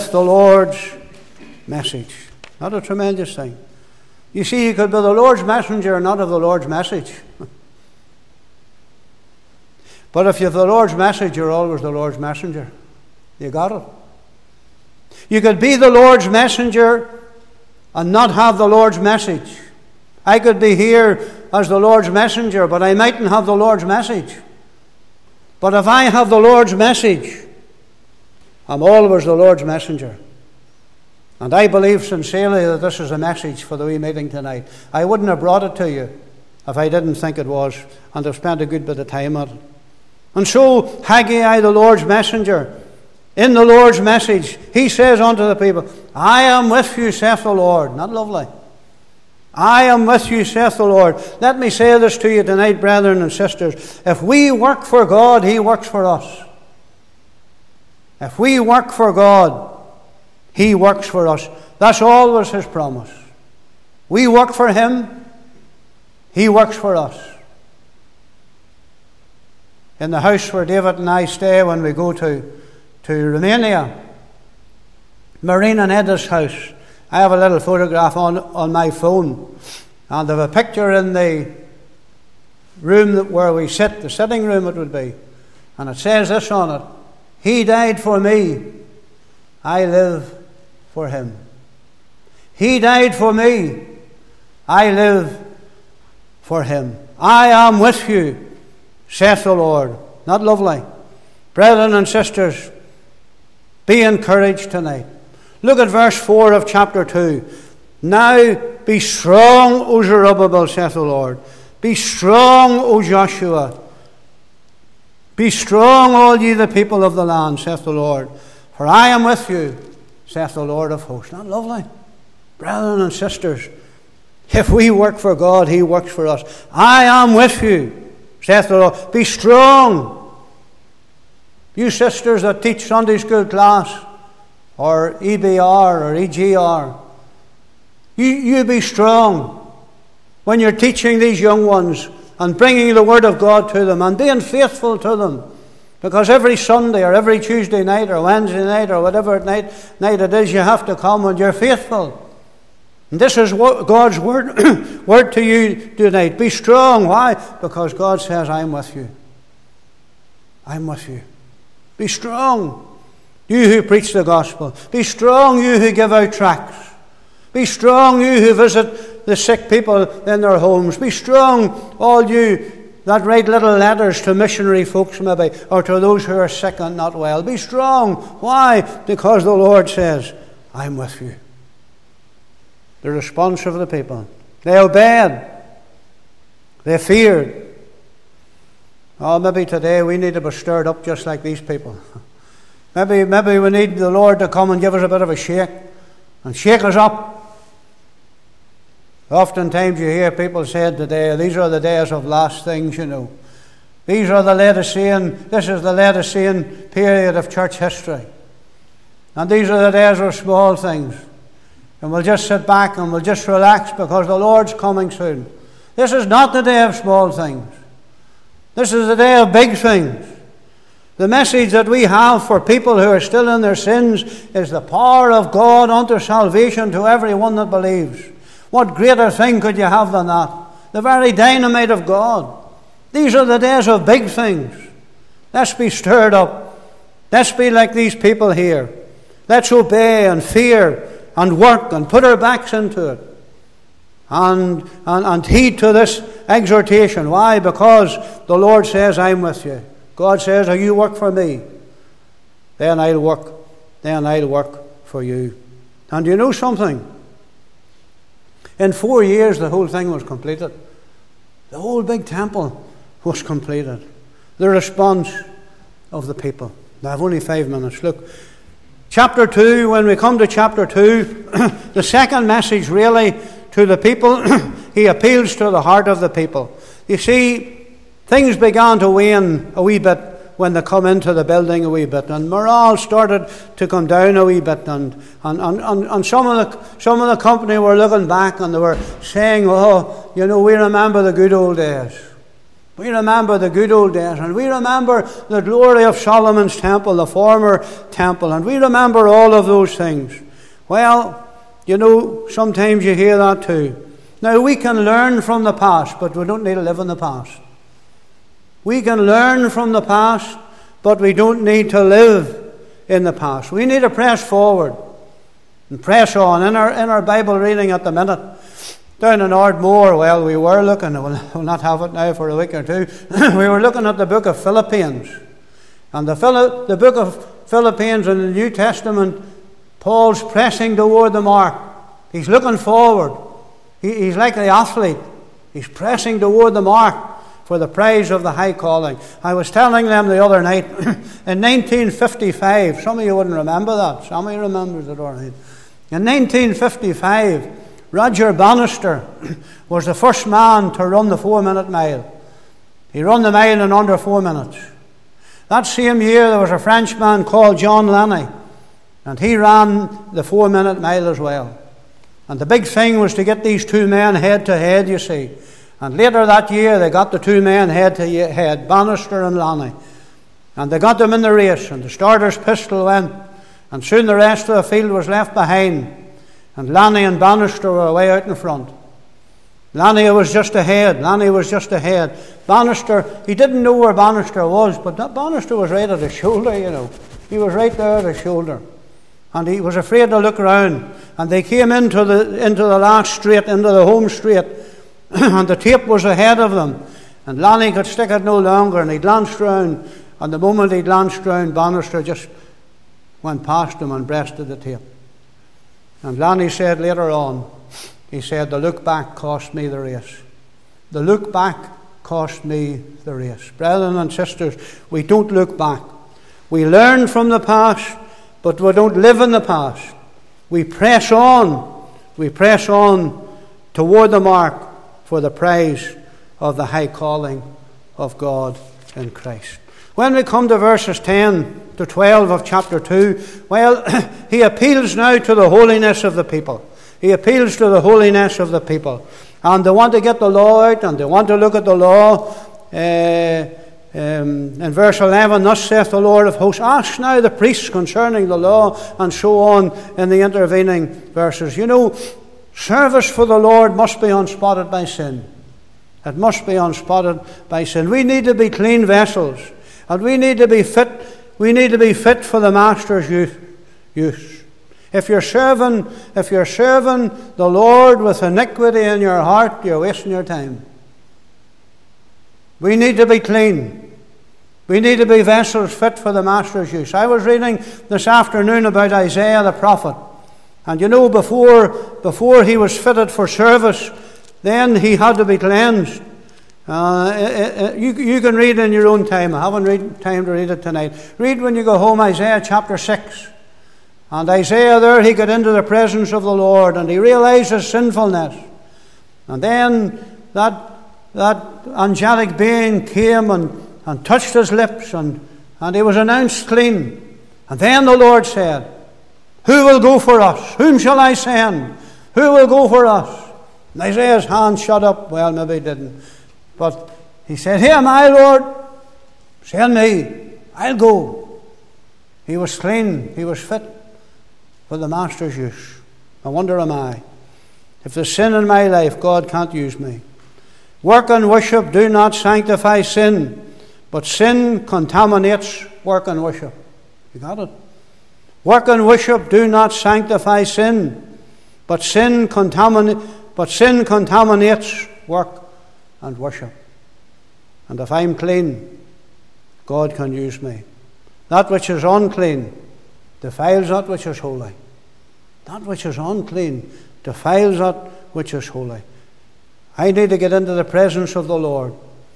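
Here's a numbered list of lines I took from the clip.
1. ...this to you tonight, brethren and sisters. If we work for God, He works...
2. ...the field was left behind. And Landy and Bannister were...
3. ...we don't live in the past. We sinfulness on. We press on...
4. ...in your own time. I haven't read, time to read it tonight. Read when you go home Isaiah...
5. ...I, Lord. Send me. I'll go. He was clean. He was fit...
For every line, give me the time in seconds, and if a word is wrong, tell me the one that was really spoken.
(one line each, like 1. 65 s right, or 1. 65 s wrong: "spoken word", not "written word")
1. 51 s right
2. 374 s right
3. 418 s wrong: "press", not "sinfulness"
4. 488 s right
5. 518 s right.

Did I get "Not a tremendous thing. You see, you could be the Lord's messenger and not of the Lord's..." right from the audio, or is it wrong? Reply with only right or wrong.
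right.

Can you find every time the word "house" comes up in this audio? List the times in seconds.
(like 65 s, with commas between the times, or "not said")
70 s, 76 s.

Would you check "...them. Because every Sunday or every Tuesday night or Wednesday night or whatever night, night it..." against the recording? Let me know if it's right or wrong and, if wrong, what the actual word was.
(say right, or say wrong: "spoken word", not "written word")
right.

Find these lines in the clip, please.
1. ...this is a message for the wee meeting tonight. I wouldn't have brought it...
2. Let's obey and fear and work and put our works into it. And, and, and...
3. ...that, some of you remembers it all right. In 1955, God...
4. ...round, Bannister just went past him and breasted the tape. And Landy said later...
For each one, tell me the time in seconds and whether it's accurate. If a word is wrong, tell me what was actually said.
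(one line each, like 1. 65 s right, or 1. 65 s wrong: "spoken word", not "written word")
1. 32 s right
2. 239 s wrong: "backs", not "works"
3. 343 s wrong: "Roger", not "God"
4. 401 s right.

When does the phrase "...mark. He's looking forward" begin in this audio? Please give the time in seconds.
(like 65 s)
331 s.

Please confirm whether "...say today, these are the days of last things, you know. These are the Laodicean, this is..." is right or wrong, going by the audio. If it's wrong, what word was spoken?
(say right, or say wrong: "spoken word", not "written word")
right.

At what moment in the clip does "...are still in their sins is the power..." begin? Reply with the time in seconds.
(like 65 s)
223 s.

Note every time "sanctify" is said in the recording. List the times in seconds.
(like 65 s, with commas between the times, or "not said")
532 s, 539 s.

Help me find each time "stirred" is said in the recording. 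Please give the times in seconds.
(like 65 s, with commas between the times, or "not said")
190 s, 235 s.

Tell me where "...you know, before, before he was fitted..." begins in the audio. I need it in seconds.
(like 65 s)
480 s.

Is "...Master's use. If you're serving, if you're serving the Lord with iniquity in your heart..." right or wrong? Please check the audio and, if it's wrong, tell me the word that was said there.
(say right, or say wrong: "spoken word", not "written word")
right.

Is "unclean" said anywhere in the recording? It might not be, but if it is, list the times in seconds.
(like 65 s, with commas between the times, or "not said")
552 s, 556 s.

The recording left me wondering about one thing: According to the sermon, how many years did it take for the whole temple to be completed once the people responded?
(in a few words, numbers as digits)
4.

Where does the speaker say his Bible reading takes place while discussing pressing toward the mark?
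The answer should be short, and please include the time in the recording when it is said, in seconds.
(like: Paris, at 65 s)
Ardmore, at 319 s.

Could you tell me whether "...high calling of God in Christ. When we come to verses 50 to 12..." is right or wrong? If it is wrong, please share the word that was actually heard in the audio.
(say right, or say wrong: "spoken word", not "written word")
wrong: "10", not "50".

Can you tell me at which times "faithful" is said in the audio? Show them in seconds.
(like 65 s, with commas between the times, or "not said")
144 s, 151 s.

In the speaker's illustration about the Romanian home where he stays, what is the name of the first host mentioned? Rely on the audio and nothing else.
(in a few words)
Marina.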